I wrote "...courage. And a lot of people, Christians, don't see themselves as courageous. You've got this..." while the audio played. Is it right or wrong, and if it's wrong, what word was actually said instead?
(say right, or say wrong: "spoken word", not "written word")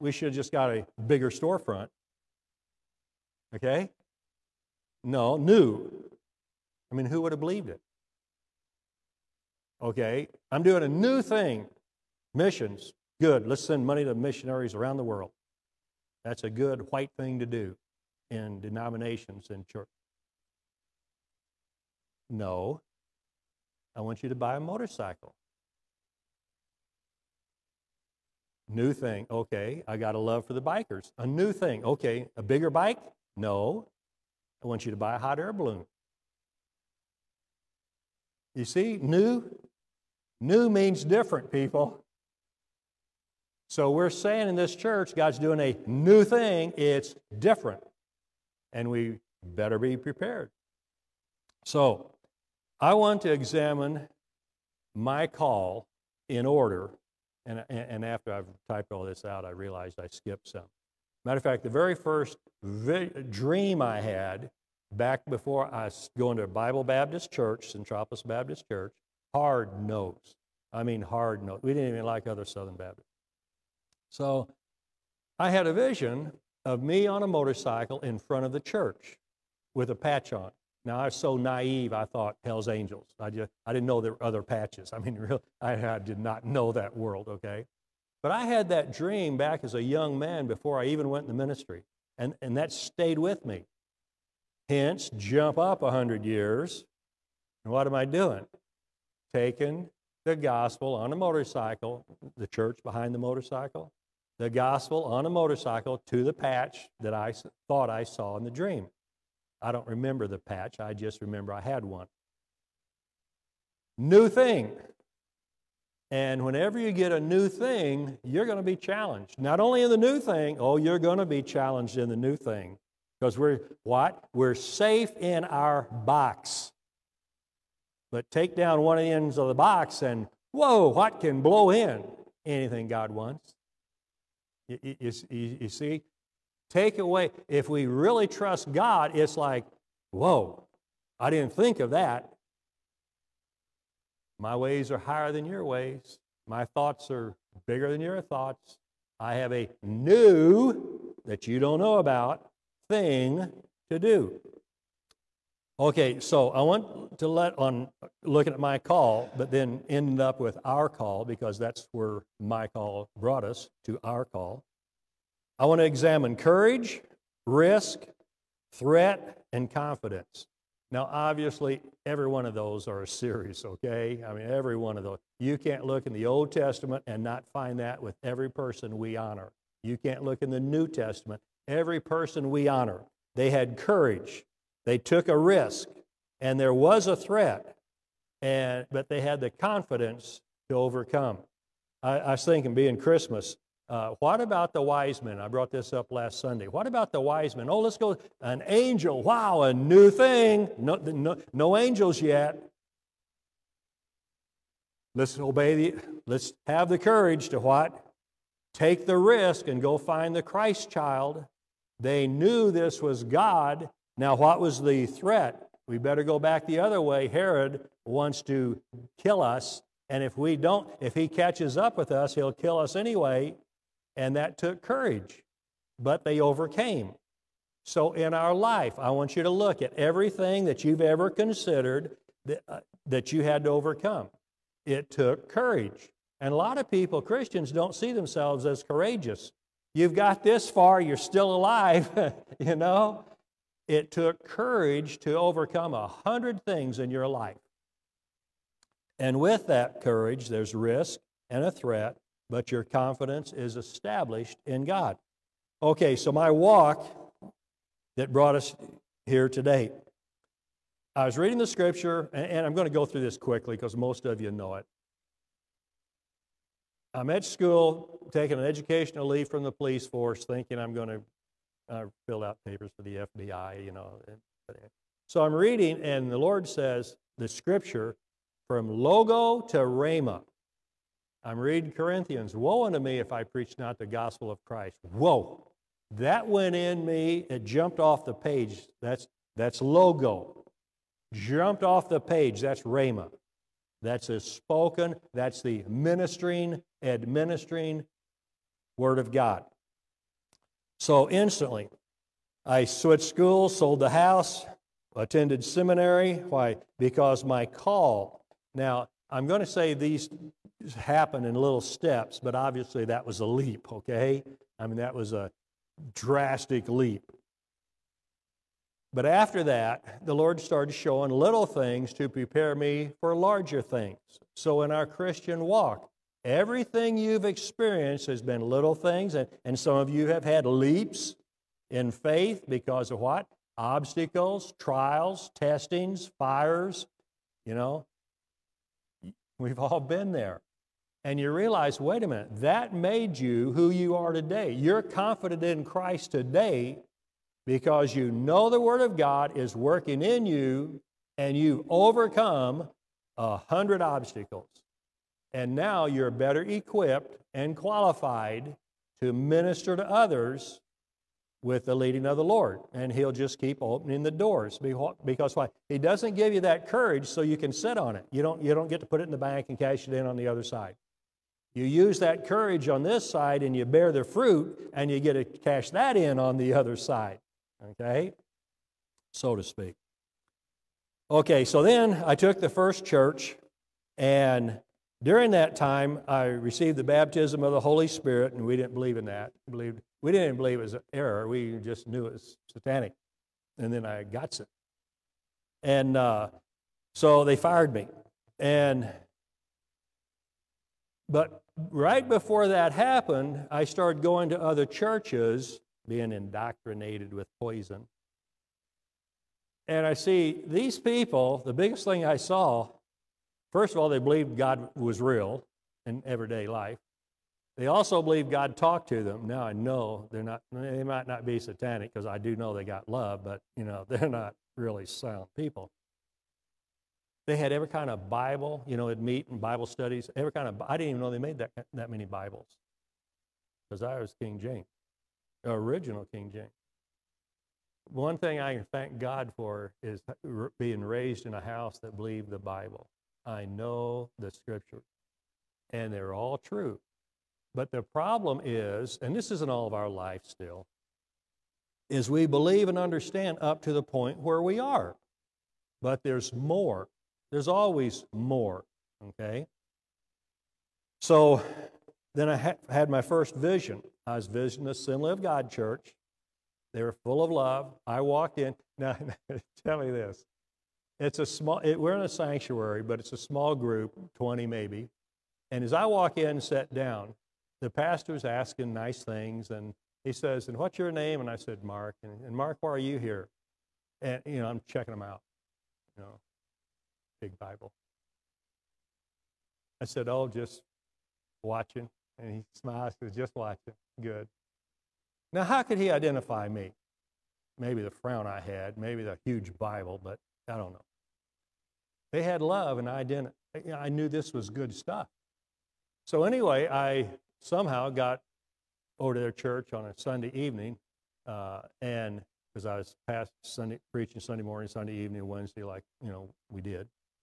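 right.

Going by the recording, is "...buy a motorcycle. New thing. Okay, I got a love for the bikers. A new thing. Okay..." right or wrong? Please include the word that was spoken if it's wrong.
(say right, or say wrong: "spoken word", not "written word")
right.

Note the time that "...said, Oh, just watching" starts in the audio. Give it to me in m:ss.
8:10.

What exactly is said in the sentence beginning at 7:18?
One thing I can thank God for is being raised in a house that believed the Bible.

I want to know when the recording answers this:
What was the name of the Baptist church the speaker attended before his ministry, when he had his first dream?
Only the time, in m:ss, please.
1:07.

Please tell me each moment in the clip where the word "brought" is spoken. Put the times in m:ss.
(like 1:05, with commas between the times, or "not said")
2:43, 3:15, 4:18.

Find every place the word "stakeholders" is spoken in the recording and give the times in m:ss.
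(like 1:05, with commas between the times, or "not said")
not said.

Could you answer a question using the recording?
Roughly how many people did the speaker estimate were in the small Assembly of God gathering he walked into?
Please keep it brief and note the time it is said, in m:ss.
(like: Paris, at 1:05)
20, at 7:54.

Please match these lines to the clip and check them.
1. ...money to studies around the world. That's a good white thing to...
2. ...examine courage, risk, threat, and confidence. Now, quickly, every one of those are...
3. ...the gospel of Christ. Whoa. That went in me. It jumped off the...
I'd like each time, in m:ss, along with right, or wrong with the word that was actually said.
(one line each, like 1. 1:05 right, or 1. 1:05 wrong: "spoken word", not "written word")
1. 0:13 wrong: "missionaries", not "studies"
2. 2:45 wrong: "obviously", not "quickly"
3. 4:43 right.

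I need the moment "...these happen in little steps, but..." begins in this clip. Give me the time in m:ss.
5:09.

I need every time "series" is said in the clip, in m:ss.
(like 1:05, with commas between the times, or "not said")
2:53.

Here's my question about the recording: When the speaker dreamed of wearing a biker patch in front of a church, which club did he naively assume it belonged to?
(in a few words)
Hell's Angels.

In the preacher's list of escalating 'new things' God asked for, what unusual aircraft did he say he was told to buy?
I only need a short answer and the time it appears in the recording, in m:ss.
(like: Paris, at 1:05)
hot air balloon, at 0:35.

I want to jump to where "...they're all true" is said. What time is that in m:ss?
7:26.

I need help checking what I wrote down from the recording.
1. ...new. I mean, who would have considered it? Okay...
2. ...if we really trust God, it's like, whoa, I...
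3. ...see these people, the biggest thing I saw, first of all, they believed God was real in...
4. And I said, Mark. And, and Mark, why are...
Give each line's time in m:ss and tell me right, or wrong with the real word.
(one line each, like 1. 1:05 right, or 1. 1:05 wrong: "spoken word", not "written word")
1. 0:05 wrong: "believed", not "considered"
2. 2:17 right
3. 6:50 right
4. 8:01 right.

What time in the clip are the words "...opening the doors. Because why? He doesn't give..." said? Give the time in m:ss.
6:03.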